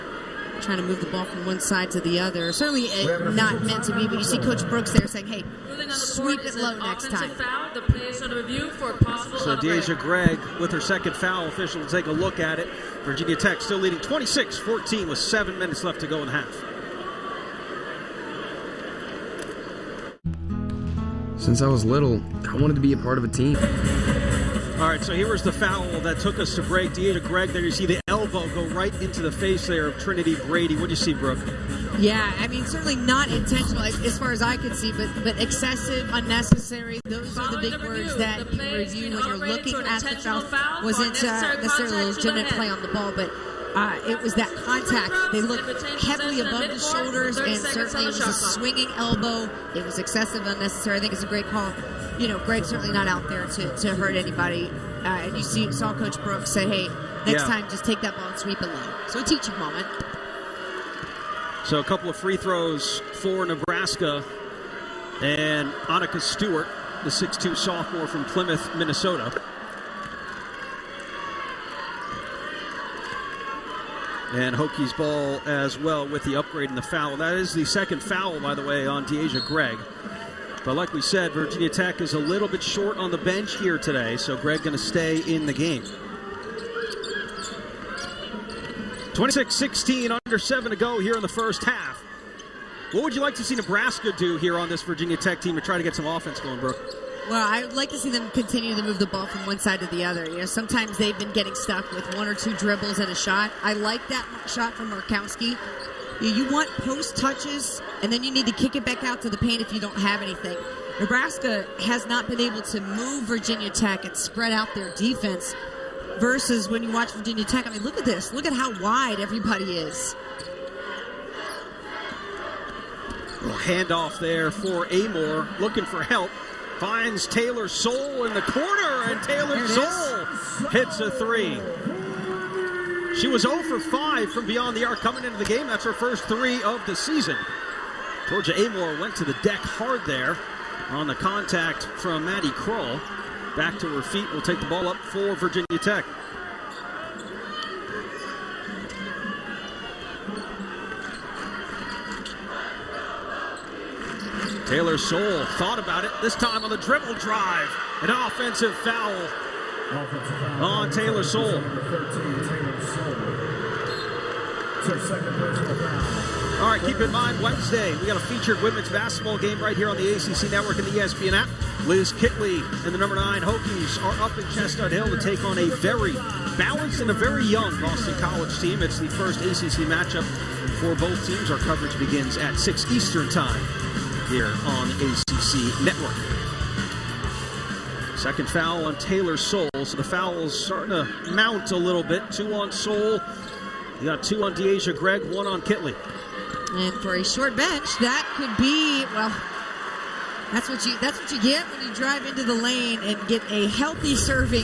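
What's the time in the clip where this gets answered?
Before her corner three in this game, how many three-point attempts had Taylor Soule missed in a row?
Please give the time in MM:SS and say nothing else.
02:13.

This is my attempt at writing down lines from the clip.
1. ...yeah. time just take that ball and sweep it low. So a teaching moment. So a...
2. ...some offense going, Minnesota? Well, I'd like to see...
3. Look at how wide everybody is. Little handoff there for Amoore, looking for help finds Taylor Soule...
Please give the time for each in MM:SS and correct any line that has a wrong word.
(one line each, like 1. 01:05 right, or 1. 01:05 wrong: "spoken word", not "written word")
1. 00:57 right
2. 01:35 wrong: "Brooke", not "Minnesota"
3. 01:58 right.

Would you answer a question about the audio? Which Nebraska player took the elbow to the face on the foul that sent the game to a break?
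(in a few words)
Trinity Brady.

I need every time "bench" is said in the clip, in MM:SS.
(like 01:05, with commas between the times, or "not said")
01:23, 03:17.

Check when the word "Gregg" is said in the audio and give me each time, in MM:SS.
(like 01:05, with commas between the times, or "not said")
00:09, 00:27, 00:52, 01:19, 01:24, 03:14.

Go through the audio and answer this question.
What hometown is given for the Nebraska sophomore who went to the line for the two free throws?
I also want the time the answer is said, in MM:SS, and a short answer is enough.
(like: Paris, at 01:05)
Plymouth, Minnesota, at 01:08.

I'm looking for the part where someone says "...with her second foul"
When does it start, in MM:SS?
00:10.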